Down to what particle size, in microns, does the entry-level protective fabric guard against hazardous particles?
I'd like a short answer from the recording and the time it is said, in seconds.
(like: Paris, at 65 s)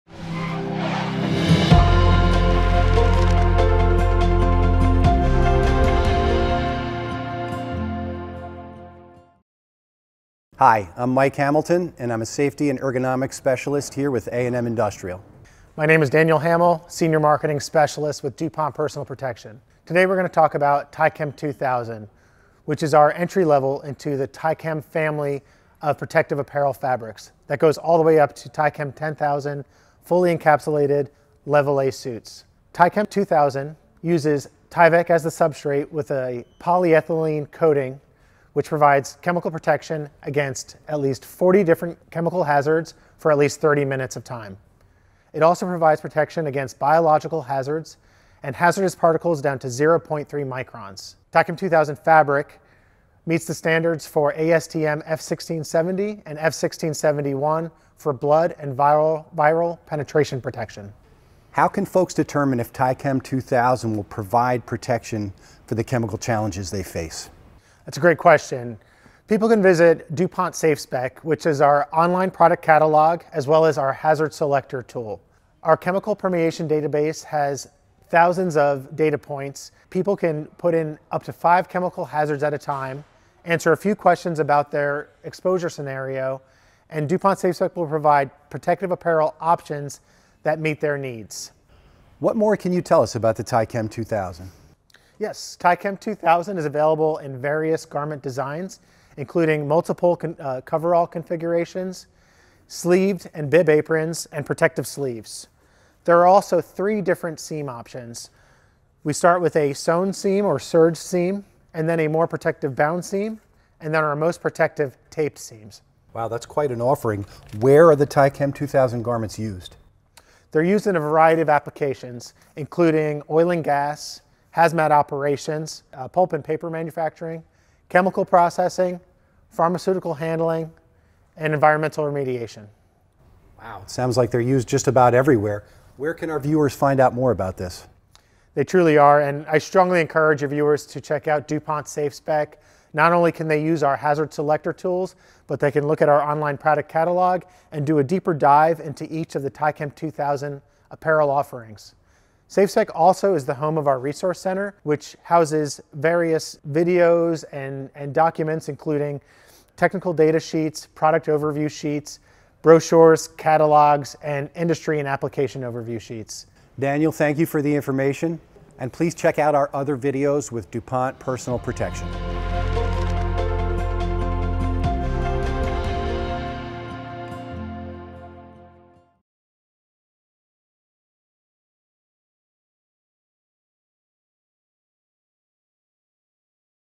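0.3 microns, at 49 s.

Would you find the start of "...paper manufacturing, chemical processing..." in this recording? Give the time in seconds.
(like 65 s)
126 s.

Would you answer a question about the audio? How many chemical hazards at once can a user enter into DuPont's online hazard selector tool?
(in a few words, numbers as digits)
5.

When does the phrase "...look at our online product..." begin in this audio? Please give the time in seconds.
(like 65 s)
145 s.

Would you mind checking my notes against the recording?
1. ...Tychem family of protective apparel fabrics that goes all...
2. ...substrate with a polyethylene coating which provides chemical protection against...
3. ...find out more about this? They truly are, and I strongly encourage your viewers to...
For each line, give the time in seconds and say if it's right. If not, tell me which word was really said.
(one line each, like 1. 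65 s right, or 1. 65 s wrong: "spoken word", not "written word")
1. 24 s right
2. 35 s right
3. 136 s right.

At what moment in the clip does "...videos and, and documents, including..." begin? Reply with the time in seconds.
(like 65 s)
156 s.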